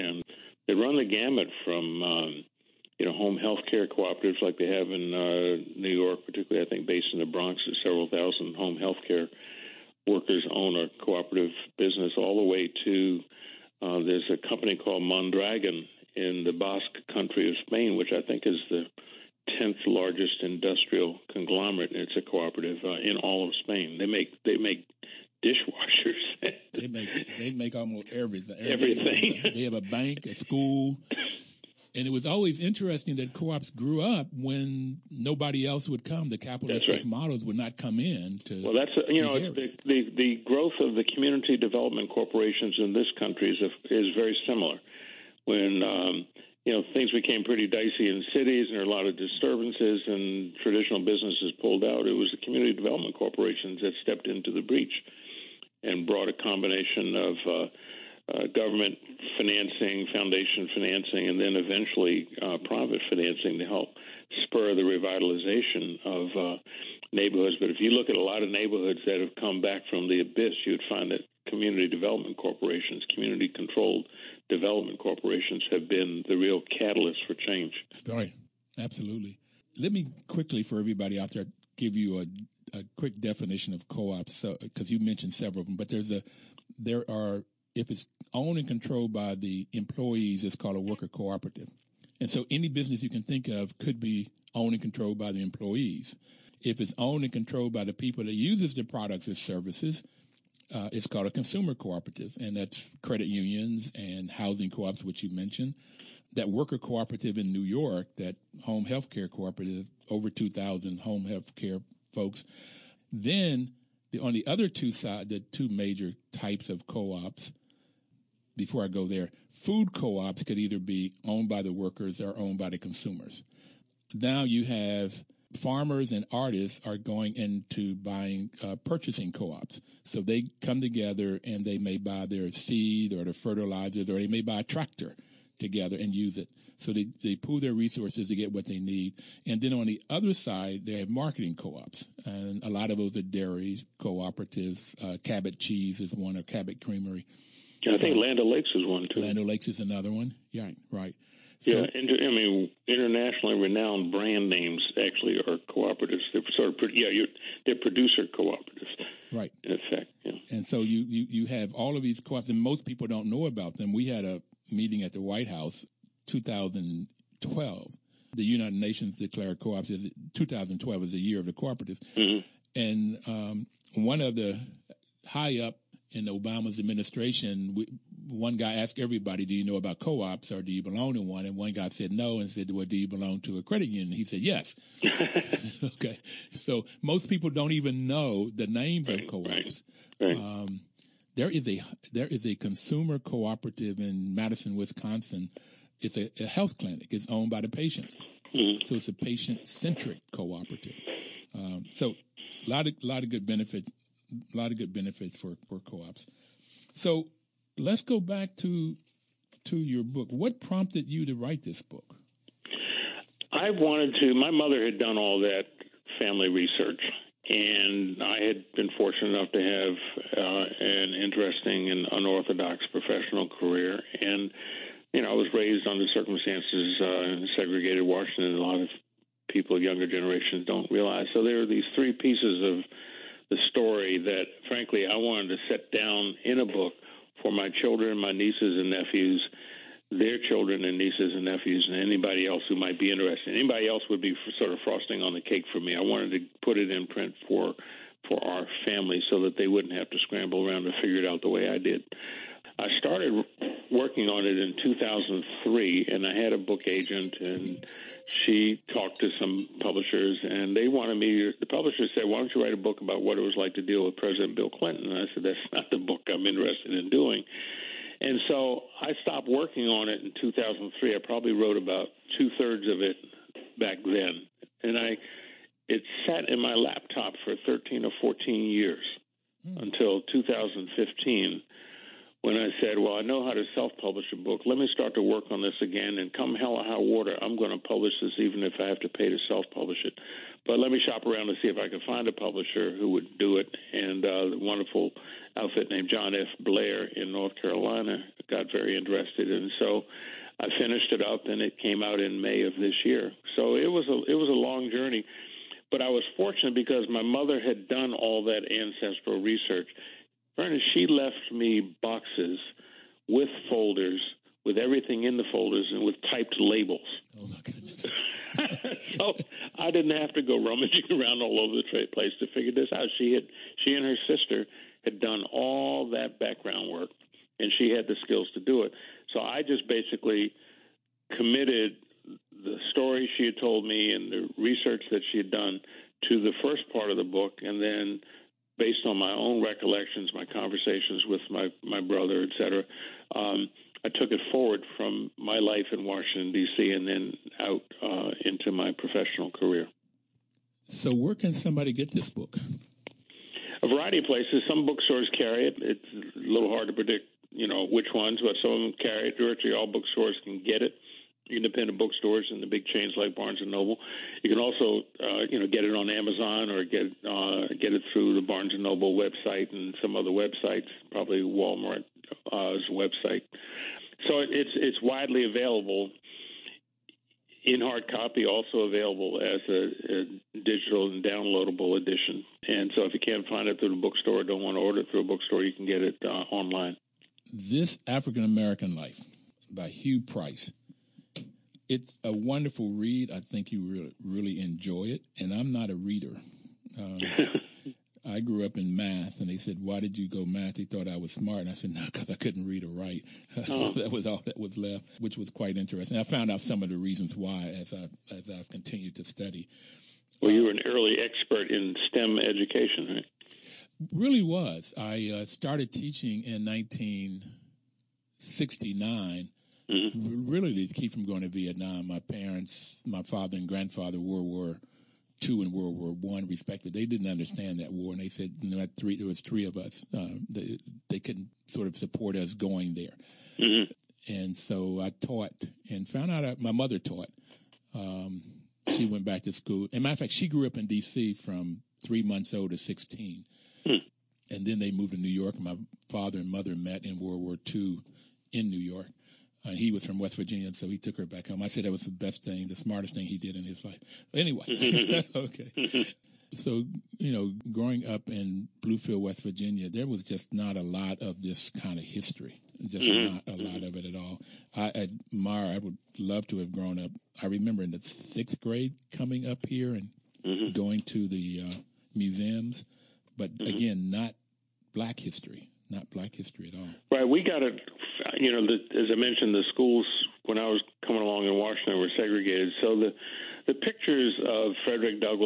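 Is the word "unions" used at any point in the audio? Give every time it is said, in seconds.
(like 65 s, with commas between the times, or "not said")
103 s, 183 s.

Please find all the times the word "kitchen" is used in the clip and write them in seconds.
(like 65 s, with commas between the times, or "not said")
not said.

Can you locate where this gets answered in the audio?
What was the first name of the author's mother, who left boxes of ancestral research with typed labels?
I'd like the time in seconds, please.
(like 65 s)
310 s.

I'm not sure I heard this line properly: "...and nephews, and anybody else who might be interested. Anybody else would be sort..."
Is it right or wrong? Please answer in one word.
right.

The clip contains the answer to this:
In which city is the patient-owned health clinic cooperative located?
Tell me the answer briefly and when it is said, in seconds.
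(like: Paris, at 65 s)
Madison, Wisconsin, at 194 s.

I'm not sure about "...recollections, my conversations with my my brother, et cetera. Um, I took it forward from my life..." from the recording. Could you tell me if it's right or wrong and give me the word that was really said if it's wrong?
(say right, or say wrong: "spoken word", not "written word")
right.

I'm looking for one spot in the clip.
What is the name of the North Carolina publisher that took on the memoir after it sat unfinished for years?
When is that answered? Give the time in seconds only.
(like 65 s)
296 s.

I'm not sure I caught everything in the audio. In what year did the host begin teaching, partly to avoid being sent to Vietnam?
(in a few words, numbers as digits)
1969.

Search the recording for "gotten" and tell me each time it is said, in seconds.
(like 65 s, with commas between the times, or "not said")
not said.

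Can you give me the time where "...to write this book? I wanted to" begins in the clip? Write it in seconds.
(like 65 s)
211 s.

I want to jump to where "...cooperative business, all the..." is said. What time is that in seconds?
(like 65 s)
11 s.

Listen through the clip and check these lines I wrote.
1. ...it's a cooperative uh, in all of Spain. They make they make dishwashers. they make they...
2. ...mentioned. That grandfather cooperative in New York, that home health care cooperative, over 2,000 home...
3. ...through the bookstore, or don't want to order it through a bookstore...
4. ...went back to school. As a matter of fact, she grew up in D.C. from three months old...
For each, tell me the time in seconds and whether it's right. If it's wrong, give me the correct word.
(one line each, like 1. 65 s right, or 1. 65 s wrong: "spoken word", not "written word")
1. 22 s right
2. 105 s wrong: "worker", not "grandfather"
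3. 383 s right
4. 439 s right.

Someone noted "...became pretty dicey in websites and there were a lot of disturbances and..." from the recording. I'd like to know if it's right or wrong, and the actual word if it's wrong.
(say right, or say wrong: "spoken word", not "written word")
wrong: "cities", not "websites".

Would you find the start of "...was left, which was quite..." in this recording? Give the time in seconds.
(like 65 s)
404 s.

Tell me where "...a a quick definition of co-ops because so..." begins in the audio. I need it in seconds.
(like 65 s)
82 s.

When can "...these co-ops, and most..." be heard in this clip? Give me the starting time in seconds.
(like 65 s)
162 s.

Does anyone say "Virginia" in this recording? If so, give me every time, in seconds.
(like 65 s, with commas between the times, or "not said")
450 s, 459 s.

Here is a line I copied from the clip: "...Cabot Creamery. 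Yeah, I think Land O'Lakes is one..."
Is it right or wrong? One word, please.
right.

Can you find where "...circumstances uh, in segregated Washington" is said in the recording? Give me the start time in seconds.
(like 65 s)
226 s.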